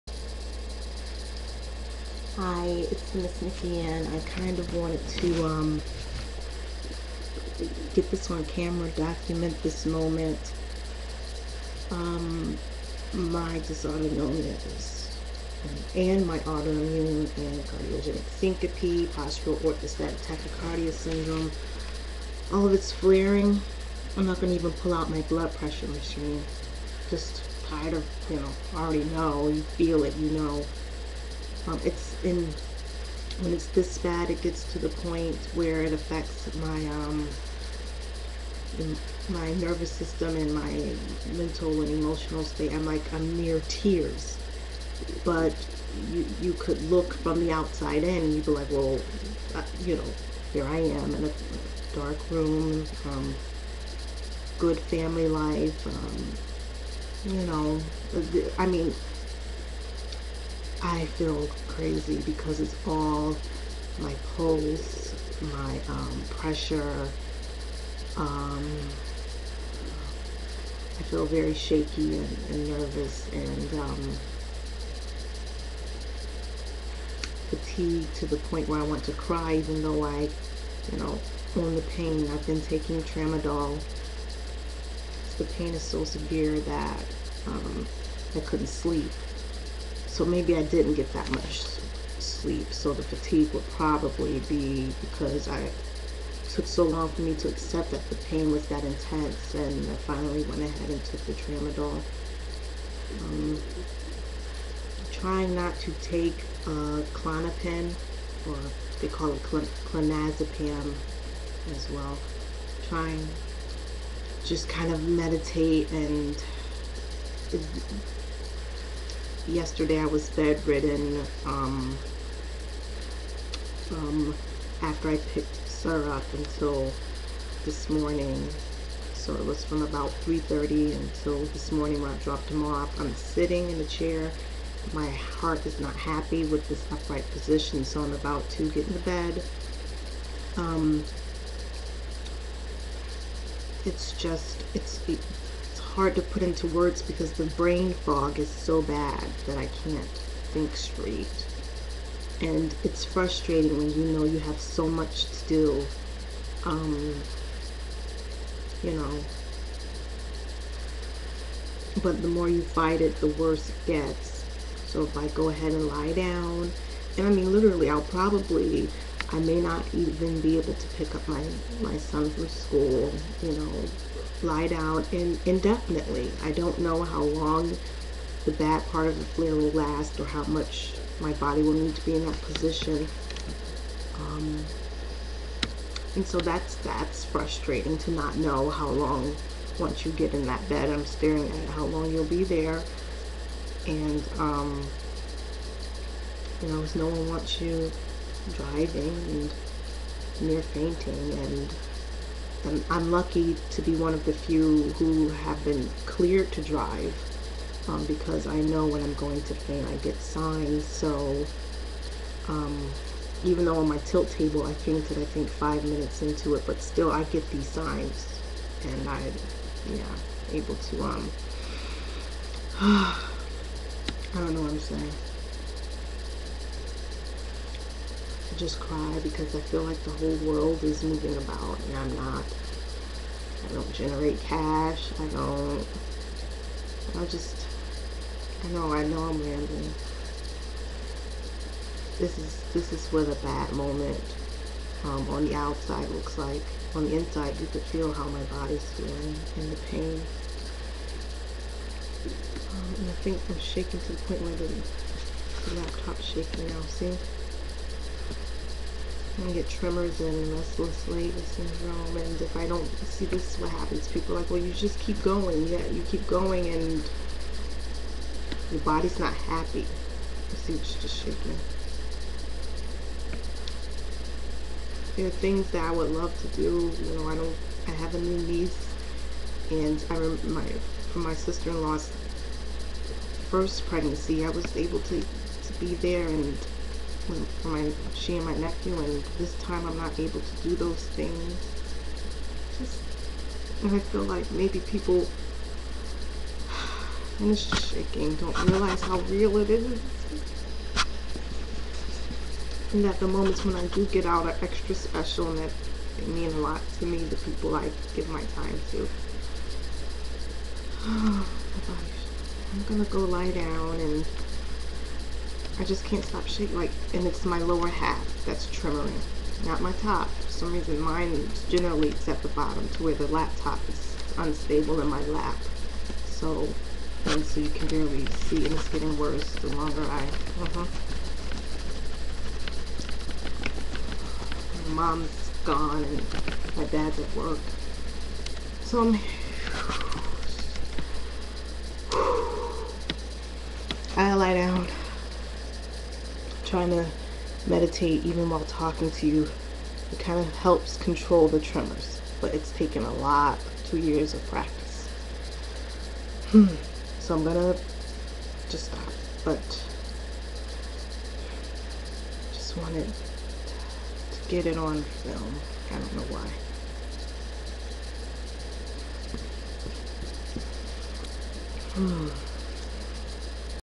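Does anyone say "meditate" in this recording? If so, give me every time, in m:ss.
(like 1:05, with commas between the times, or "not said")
1:55, 5:47.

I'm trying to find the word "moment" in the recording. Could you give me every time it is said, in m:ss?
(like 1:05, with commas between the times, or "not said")
0:09, 4:03, 5:03.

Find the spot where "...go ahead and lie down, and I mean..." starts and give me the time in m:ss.
2:45.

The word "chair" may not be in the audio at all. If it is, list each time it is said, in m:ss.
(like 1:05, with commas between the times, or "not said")
2:13.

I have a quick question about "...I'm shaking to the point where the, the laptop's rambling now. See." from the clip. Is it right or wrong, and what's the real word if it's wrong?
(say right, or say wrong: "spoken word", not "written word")
wrong: "shaking", not "rambling".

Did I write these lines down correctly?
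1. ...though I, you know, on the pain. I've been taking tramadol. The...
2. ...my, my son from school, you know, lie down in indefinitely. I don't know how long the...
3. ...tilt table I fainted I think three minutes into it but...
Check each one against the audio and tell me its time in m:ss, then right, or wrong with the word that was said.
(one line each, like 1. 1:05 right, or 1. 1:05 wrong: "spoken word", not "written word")
1. 1:19 right
2. 2:51 right
3. 3:33 wrong: "five", not "three".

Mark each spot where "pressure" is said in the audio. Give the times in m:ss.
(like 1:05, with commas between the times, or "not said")
0:25, 1:06.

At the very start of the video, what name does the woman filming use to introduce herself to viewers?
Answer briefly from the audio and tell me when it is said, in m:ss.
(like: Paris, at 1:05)
Miss Nikki, at 0:03.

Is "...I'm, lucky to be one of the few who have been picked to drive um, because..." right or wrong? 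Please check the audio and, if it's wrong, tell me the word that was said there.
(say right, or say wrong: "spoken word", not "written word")
wrong: "cleared", not "picked".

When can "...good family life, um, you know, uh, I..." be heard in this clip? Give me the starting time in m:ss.
0:54.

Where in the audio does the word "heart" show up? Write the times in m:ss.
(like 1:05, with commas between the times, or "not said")
2:15.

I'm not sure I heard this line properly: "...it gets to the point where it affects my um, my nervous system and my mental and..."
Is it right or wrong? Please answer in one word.
right.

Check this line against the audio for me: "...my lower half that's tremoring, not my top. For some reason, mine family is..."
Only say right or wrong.
wrong.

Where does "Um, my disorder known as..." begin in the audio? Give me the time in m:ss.
0:11.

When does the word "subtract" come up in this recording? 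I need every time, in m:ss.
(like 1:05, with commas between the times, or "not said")
not said.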